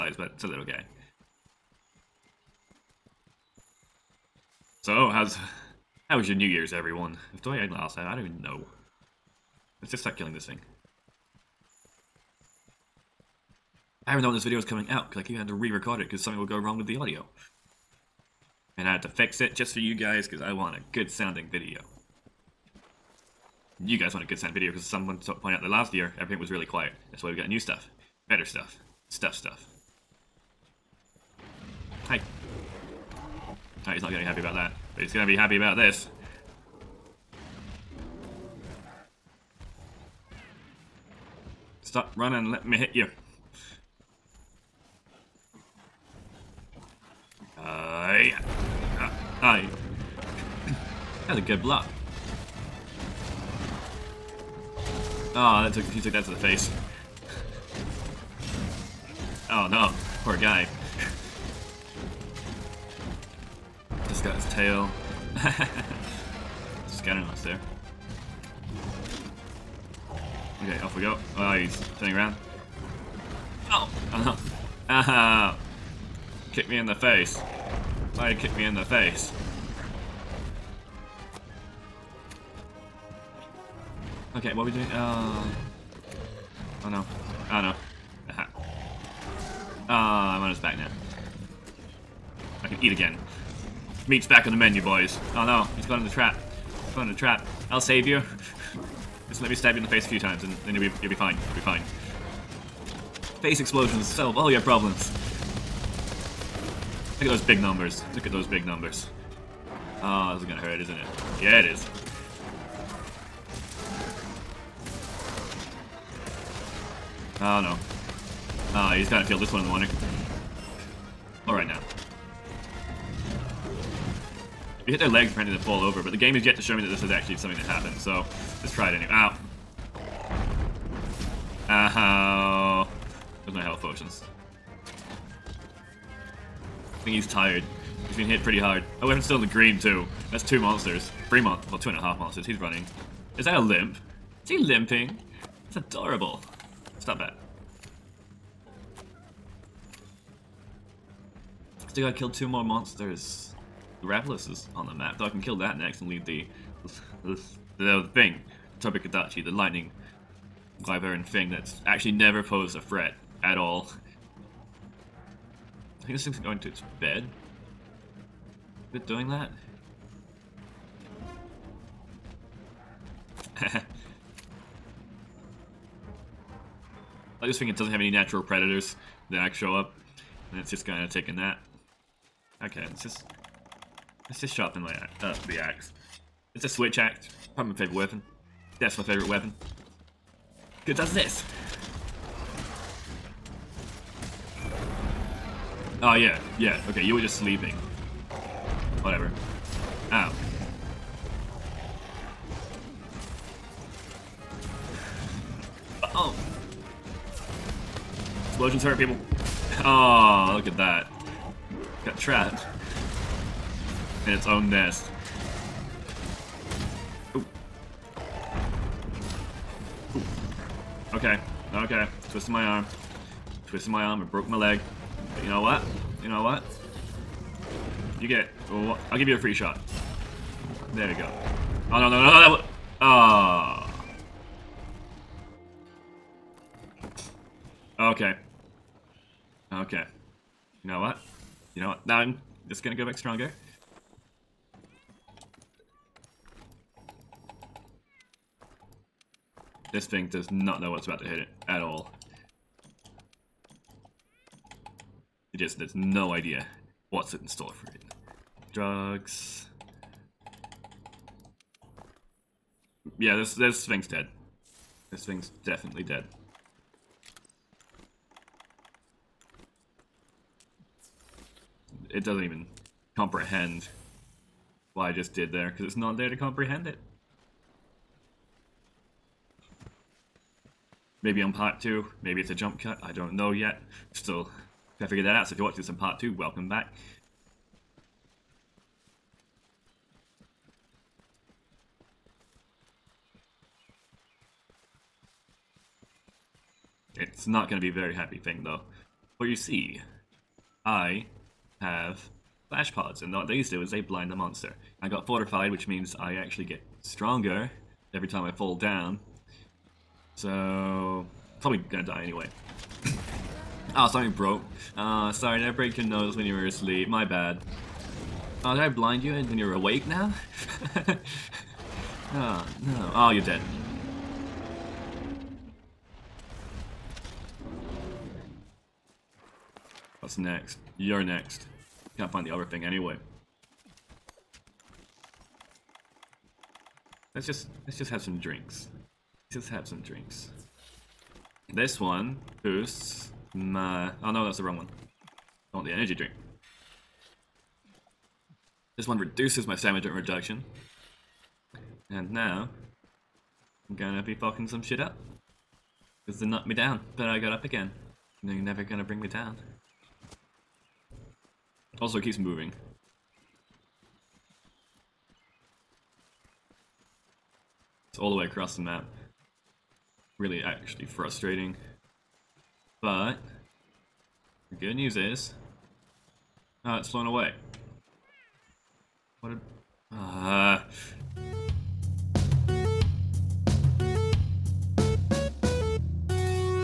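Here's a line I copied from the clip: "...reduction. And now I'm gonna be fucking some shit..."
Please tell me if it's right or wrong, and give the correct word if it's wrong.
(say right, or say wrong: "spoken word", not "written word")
right.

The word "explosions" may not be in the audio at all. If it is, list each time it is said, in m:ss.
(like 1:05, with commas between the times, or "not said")
1:43, 3:28.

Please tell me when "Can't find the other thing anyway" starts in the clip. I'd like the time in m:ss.
5:32.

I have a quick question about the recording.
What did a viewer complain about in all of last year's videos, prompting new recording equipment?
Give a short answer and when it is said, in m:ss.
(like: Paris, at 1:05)
really quiet, at 0:26.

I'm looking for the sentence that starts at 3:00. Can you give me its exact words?
And it's just kind of taking that.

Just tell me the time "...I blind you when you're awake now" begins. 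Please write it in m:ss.
5:18.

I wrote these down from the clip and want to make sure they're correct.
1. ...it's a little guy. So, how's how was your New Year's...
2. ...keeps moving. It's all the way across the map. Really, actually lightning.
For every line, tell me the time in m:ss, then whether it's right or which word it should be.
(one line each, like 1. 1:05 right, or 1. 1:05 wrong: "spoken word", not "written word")
1. 0:00 right
2. 6:02 wrong: "frustrating", not "lightning".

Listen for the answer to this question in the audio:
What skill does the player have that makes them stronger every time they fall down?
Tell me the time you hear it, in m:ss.
5:05.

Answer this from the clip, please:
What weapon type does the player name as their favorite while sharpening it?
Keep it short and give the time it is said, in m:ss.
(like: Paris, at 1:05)
switch axe, at 3:06.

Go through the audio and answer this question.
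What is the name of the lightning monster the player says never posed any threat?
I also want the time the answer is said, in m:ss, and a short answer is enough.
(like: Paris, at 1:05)
Tobi-Kadachi, at 2:38.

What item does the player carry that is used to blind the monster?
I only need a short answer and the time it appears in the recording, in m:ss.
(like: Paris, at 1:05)
flash pods, at 5:02.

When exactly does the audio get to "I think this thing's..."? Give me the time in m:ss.
2:46.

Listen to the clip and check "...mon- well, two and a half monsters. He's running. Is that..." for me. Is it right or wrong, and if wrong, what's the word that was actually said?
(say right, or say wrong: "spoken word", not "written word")
right.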